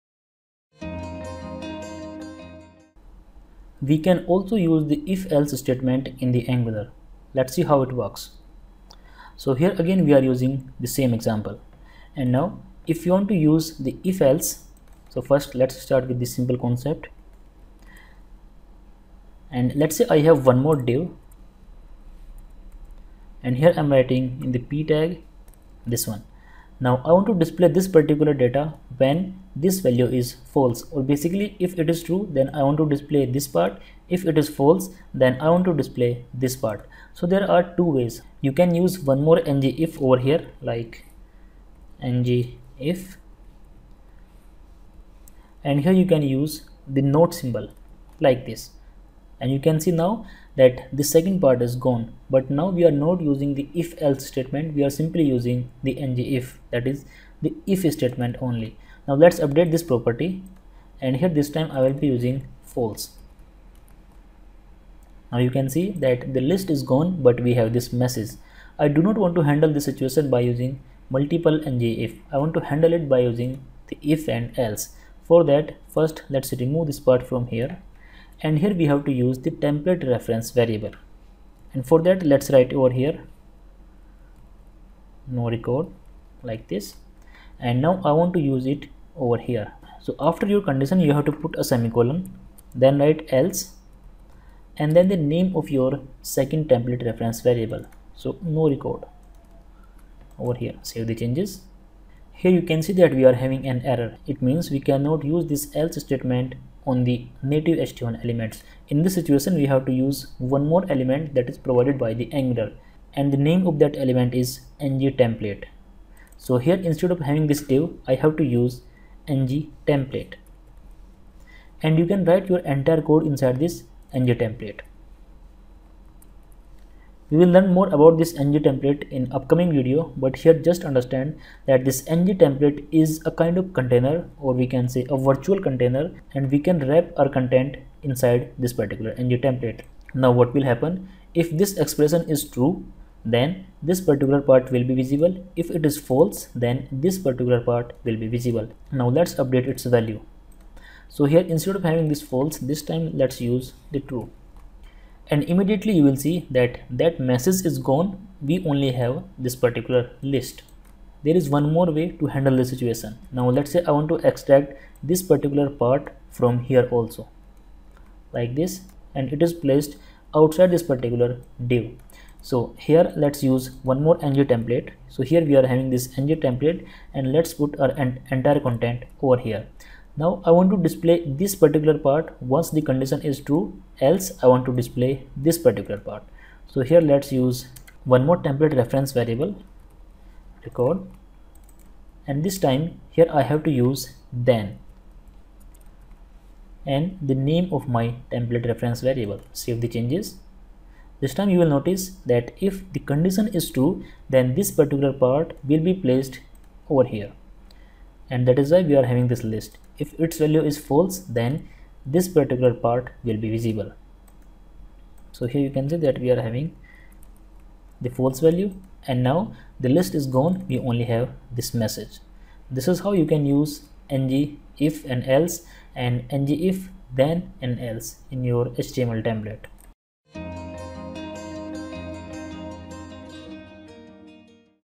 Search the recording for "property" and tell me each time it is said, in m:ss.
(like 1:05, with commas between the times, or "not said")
0:59.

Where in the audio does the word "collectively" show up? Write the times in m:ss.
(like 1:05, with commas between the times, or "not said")
not said.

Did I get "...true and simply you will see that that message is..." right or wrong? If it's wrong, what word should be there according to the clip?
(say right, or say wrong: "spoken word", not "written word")
wrong: "immediately", not "simply".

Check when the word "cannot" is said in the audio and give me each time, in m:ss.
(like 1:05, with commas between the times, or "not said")
1:44.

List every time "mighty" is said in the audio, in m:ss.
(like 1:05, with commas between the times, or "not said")
not said.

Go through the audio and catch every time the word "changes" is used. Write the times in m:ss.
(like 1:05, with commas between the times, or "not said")
1:41, 3:19.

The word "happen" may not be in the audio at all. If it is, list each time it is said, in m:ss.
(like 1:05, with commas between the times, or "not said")
2:20.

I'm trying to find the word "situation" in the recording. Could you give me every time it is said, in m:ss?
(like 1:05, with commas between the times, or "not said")
1:09, 1:49, 2:42.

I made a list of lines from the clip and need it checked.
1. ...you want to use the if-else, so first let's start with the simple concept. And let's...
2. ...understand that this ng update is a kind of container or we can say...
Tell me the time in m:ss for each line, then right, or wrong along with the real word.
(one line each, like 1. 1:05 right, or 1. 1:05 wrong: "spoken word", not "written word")
1. 0:13 right
2. 2:10 wrong: "template", not "update".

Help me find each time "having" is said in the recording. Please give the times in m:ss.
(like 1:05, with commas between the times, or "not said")
1:43, 1:57, 2:31, 2:55, 3:29, 3:36.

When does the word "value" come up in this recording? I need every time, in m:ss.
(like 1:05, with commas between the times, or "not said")
0:29, 2:29, 3:30, 3:38.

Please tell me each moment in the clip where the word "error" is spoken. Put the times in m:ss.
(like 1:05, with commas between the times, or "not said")
1:43.